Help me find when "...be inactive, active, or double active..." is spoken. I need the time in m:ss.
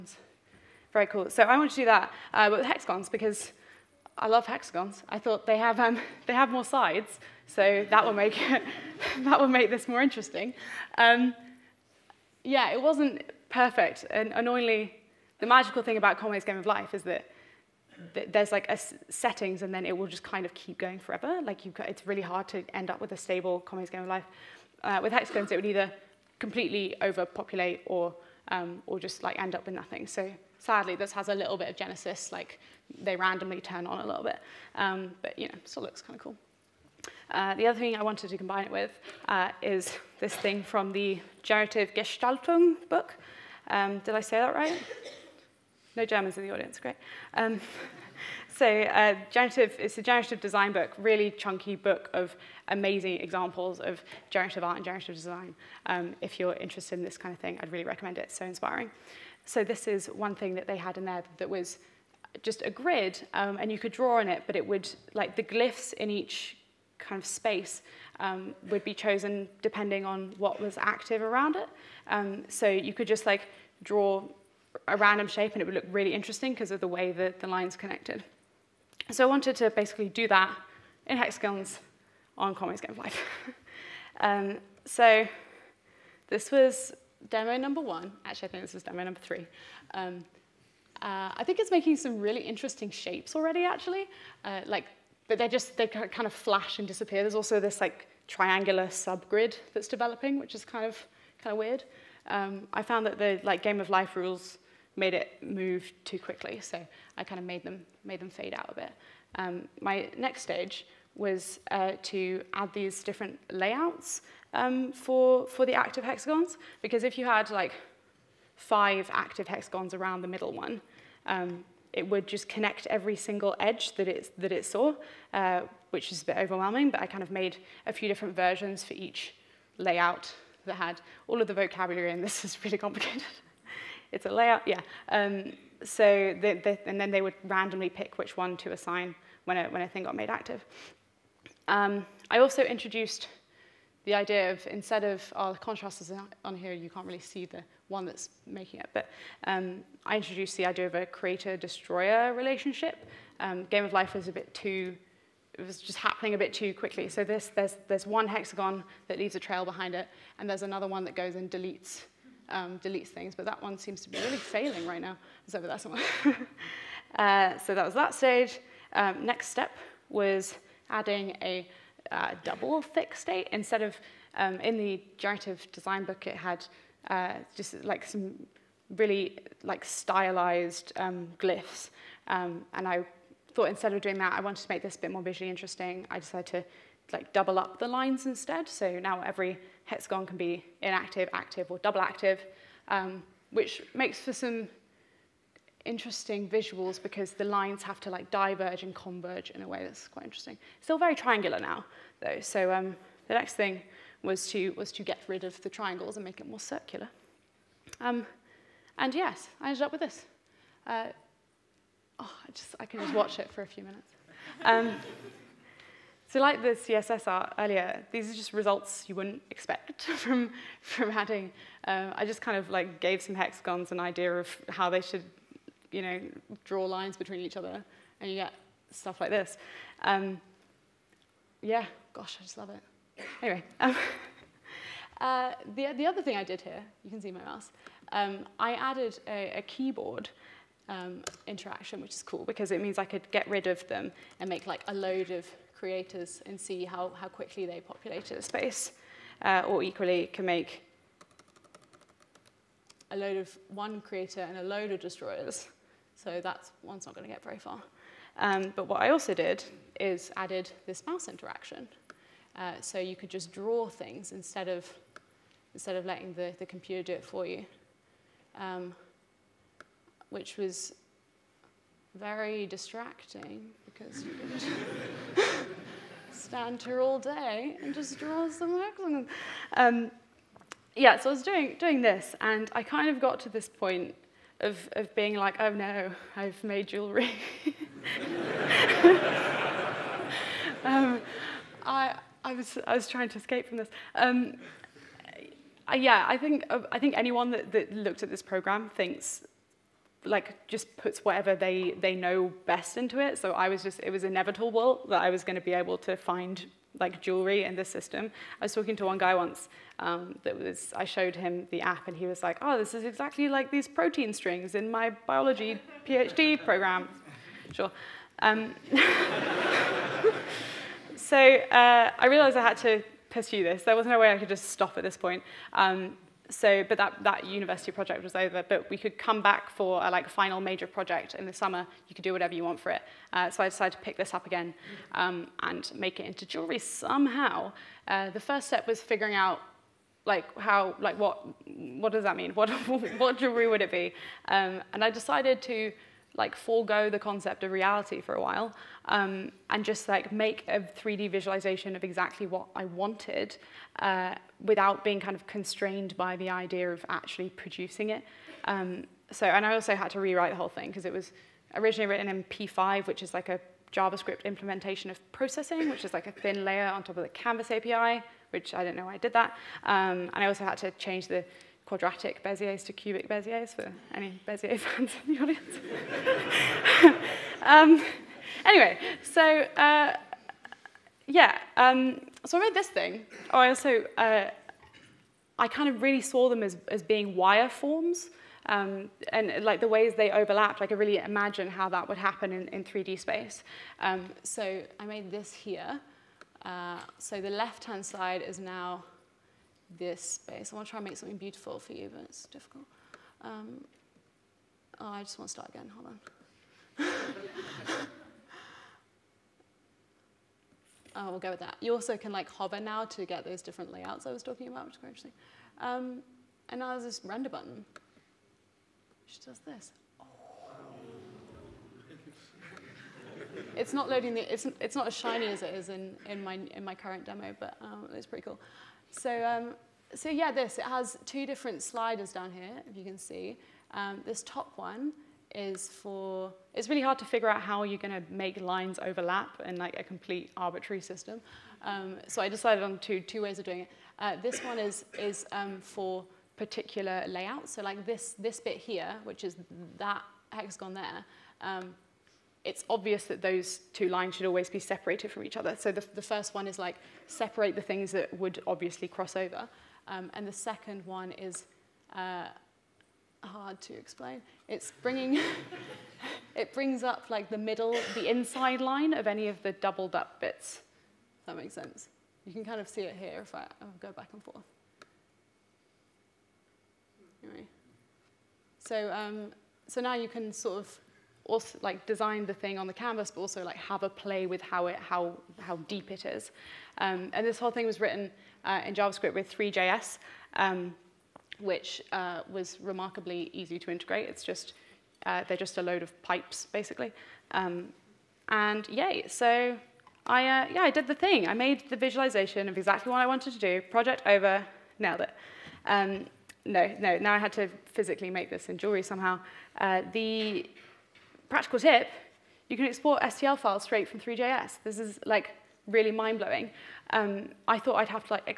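3:10.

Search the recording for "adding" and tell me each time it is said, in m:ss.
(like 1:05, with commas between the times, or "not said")
2:50, 3:41.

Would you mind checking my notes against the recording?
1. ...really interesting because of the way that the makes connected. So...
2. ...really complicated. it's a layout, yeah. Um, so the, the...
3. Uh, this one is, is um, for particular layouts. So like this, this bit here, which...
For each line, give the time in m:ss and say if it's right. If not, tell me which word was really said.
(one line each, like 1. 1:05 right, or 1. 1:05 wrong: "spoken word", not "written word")
1. 1:15 wrong: "lines", not "makes"
2. 2:12 right
3. 7:24 right.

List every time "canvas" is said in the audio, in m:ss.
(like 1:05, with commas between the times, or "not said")
6:07, 8:02.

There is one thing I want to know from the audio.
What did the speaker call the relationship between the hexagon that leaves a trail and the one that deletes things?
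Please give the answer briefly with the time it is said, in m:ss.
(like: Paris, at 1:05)
Creator-destroyer, at 2:31.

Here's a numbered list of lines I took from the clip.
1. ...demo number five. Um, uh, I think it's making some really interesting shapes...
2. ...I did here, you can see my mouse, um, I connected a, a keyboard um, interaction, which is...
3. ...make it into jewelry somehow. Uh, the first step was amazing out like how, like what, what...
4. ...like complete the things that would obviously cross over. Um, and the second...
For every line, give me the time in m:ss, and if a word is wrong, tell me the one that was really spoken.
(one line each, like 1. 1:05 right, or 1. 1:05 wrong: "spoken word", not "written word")
1. 1:28 wrong: "three", not "five"
2. 3:56 wrong: "added", not "connected"
3. 5:35 wrong: "figuring", not "amazing"
4. 7:36 wrong: "separate", not "complete".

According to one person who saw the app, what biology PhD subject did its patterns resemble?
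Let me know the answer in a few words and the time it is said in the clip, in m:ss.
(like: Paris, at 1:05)
Protein strings, at 5:13.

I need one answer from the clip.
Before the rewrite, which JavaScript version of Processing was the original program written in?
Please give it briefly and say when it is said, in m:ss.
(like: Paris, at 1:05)
P5, at 6:02.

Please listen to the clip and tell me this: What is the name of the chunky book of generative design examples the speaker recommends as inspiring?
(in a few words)
Generative Gestaltung.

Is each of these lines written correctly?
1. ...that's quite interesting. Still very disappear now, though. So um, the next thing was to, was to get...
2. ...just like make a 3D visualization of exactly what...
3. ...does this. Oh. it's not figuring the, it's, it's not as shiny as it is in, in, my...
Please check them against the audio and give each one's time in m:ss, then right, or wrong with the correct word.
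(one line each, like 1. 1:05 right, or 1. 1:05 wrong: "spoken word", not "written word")
1. 3:19 wrong: "triangular", not "disappear"
2. 5:49 right
3. 6:59 wrong: "loading", not "figuring".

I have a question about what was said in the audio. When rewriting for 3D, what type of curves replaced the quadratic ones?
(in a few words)
Cubic Beziers.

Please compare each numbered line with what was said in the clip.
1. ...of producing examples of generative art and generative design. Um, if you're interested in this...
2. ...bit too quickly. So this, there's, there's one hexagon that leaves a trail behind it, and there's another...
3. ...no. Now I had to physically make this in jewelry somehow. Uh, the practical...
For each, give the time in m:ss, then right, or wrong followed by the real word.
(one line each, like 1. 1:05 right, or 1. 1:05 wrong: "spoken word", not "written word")
1. 0:52 wrong: "amazing", not "producing"
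2. 2:36 right
3. 8:26 right.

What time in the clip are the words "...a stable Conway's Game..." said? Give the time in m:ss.
0:23.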